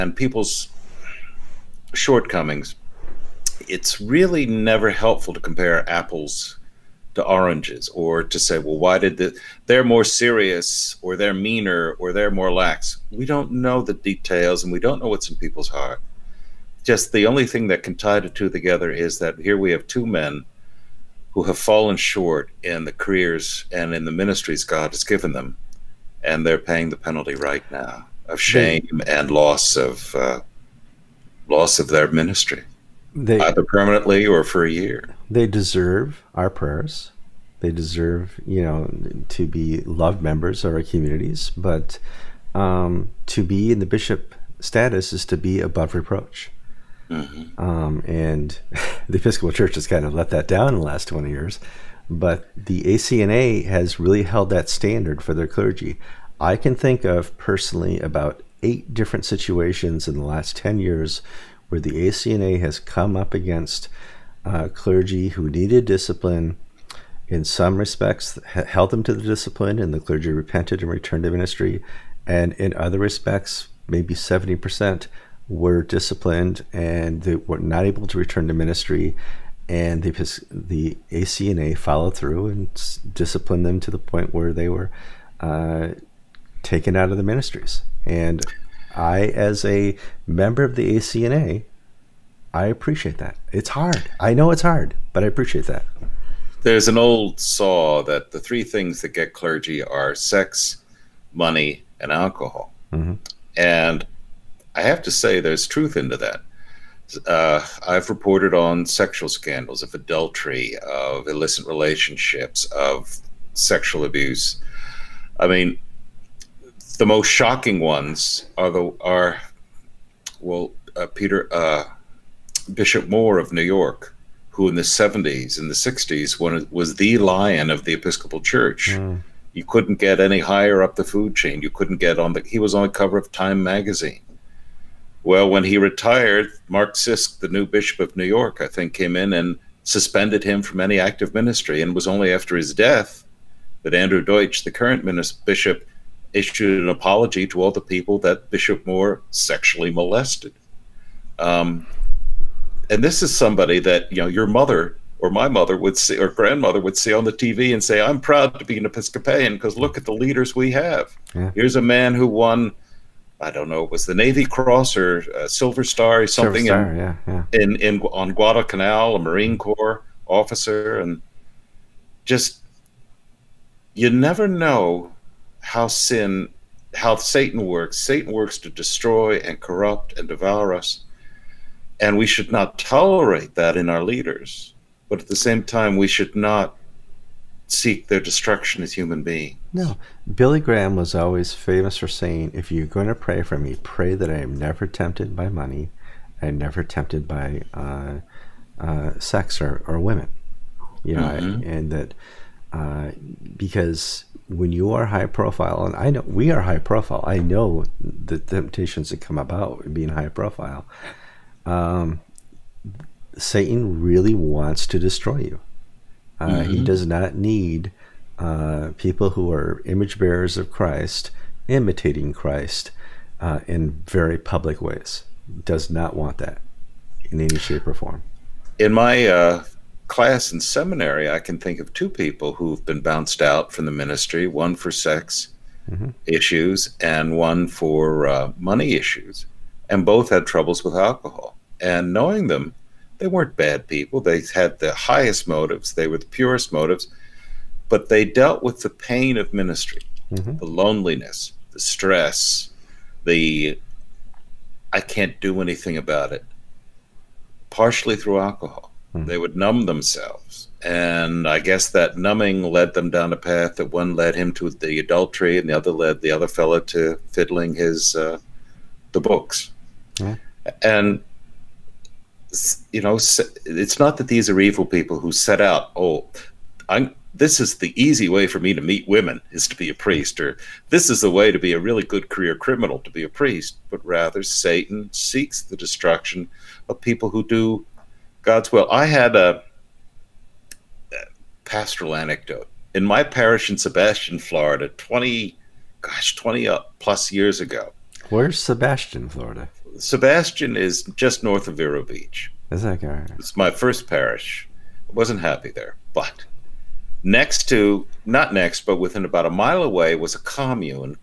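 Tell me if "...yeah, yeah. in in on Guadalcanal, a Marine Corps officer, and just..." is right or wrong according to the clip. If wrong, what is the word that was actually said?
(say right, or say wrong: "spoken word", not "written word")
right.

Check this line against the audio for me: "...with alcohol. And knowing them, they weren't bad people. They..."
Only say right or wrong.
right.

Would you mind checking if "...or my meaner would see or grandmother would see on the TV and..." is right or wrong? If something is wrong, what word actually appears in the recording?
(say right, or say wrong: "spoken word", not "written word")
wrong: "mother", not "meaner".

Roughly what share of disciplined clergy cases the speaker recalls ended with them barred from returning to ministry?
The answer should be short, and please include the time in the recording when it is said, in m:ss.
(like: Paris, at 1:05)
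70%, at 1:14.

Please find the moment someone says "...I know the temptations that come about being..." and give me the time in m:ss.
3:27.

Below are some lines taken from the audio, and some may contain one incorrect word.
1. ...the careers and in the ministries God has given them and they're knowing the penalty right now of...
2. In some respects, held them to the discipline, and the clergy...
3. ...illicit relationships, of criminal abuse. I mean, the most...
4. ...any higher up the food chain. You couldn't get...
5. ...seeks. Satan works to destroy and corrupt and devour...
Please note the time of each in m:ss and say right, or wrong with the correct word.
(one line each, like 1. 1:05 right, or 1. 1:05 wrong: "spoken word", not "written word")
1. 0:22 wrong: "paying", not "knowing"
2. 1:07 right
3. 1:51 wrong: "sexual", not "criminal"
4. 2:10 right
5. 2:57 wrong: "works", not "seeks".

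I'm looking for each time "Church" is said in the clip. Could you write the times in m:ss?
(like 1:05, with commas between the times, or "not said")
0:49, 2:08.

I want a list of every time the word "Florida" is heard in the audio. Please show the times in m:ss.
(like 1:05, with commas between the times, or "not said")
4:54, 4:59.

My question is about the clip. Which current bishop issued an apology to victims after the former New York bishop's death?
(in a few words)
Andrew Dietsche.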